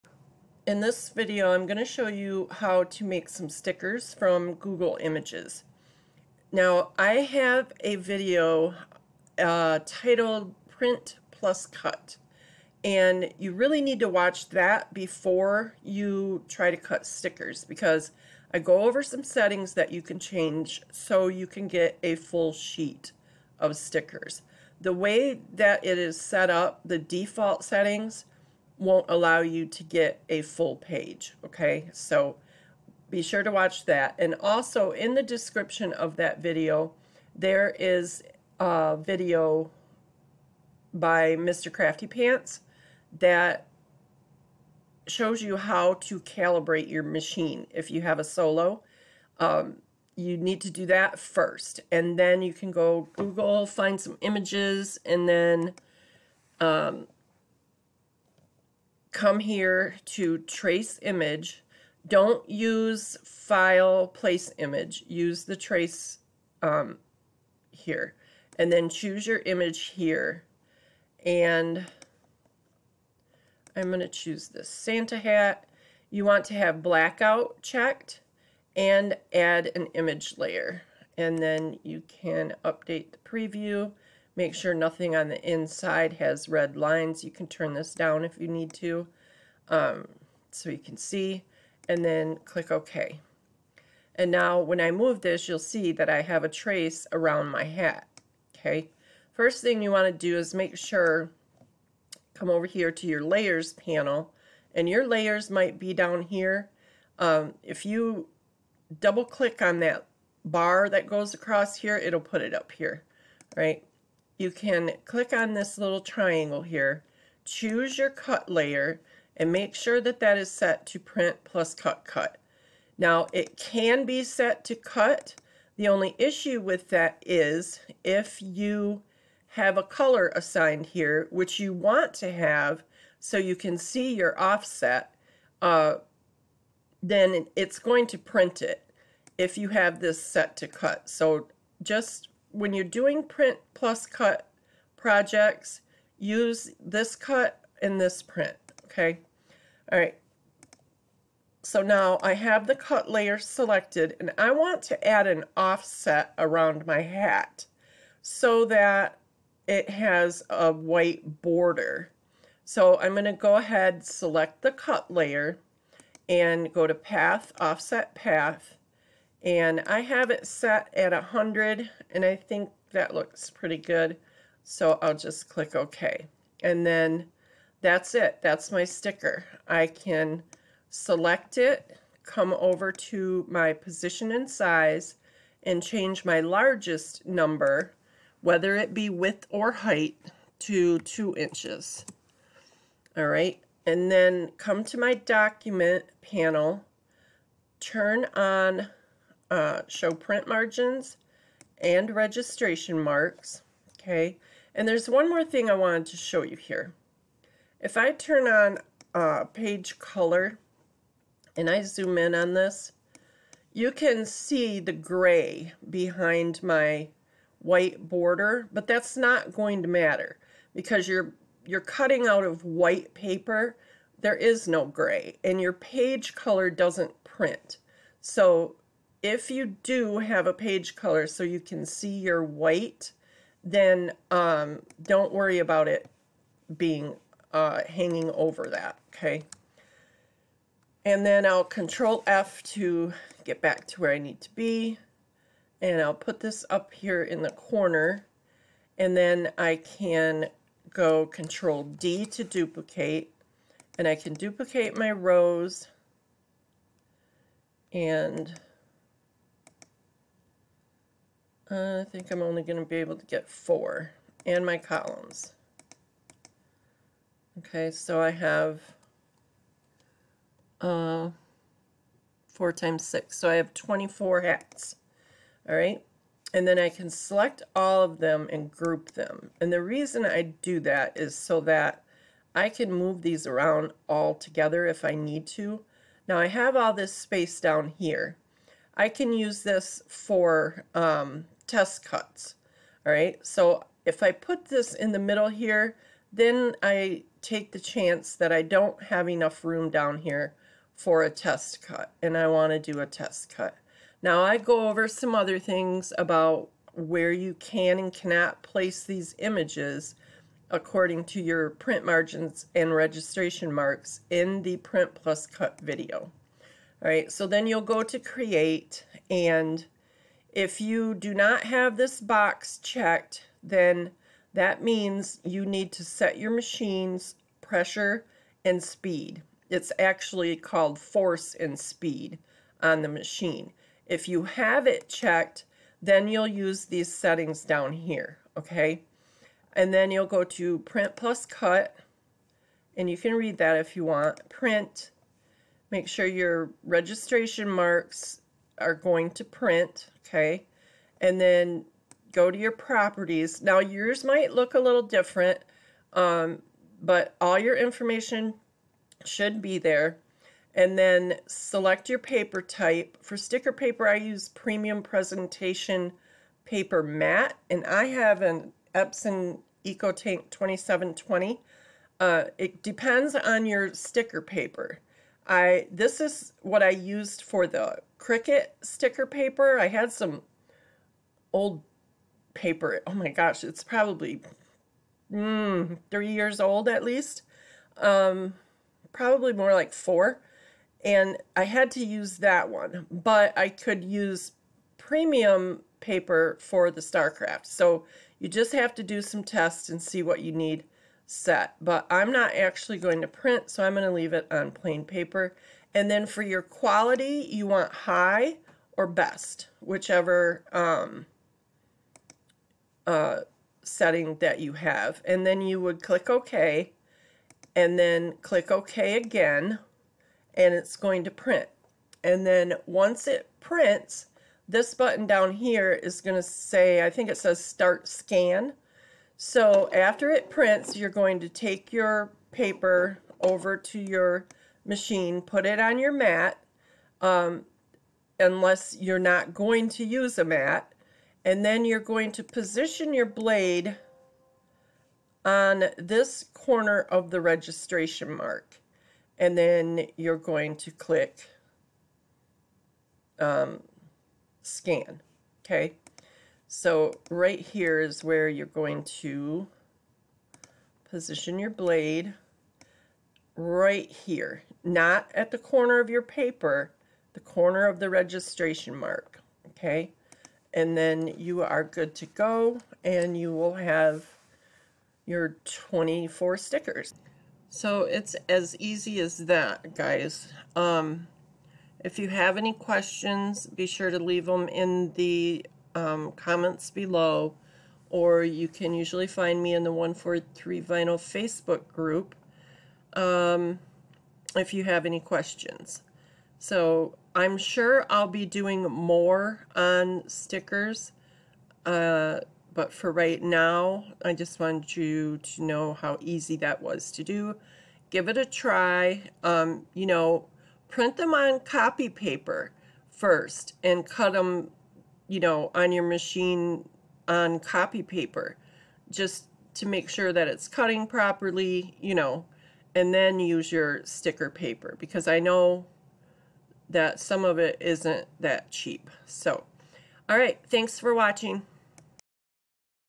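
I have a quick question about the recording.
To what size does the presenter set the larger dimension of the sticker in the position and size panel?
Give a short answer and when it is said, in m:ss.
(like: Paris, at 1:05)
2 inches, at 3:10.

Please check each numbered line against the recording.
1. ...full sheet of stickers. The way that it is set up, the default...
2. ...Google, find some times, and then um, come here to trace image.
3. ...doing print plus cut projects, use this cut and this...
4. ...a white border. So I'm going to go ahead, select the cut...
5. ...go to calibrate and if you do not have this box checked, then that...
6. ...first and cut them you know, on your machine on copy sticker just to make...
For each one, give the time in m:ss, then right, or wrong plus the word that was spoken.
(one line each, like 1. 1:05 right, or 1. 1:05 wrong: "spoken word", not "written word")
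1. 0:22 right
2. 0:53 wrong: "images", not "times"
3. 2:22 right
4. 2:40 right
5. 5:17 wrong: "create", not "calibrate"
6. 8:33 wrong: "paper", not "sticker".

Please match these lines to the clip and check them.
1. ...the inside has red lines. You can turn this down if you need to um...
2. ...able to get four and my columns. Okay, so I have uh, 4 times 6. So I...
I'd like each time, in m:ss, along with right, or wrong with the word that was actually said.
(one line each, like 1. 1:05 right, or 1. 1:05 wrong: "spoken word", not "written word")
1. 1:25 right
2. 4:22 right.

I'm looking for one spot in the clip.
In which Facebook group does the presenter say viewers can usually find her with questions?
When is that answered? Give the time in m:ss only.
8:09.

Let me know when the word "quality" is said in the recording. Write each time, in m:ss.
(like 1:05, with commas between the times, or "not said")
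6:46.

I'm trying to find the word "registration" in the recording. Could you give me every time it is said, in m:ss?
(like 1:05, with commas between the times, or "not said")
3:22, 5:12, 5:46, 7:27, 7:48.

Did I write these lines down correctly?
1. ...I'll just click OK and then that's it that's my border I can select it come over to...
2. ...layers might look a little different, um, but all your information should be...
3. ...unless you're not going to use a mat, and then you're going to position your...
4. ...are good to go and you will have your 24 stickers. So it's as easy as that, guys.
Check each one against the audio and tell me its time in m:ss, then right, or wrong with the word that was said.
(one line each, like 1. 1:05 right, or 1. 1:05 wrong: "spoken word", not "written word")
1. 2:55 wrong: "sticker", not "border"
2. 5:53 wrong: "yours", not "layers"
3. 7:18 right
4. 7:51 right.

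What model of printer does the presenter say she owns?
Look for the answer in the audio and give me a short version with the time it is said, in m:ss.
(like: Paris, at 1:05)
Epson EcoTank 2720, at 6:08.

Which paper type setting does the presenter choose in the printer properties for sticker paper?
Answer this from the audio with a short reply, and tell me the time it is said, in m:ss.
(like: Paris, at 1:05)
Premium Presentation Paper Matte, at 6:04.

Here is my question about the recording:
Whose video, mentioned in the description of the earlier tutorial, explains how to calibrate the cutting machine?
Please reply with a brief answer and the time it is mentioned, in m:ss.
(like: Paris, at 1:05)
Mr. Crafty Pants, at 0:41.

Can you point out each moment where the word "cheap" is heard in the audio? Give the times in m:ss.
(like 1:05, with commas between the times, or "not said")
8:48.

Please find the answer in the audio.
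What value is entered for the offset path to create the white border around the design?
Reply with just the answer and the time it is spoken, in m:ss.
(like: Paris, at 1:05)
100, at 2:51.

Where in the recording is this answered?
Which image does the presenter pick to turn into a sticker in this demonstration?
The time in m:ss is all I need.
1:14.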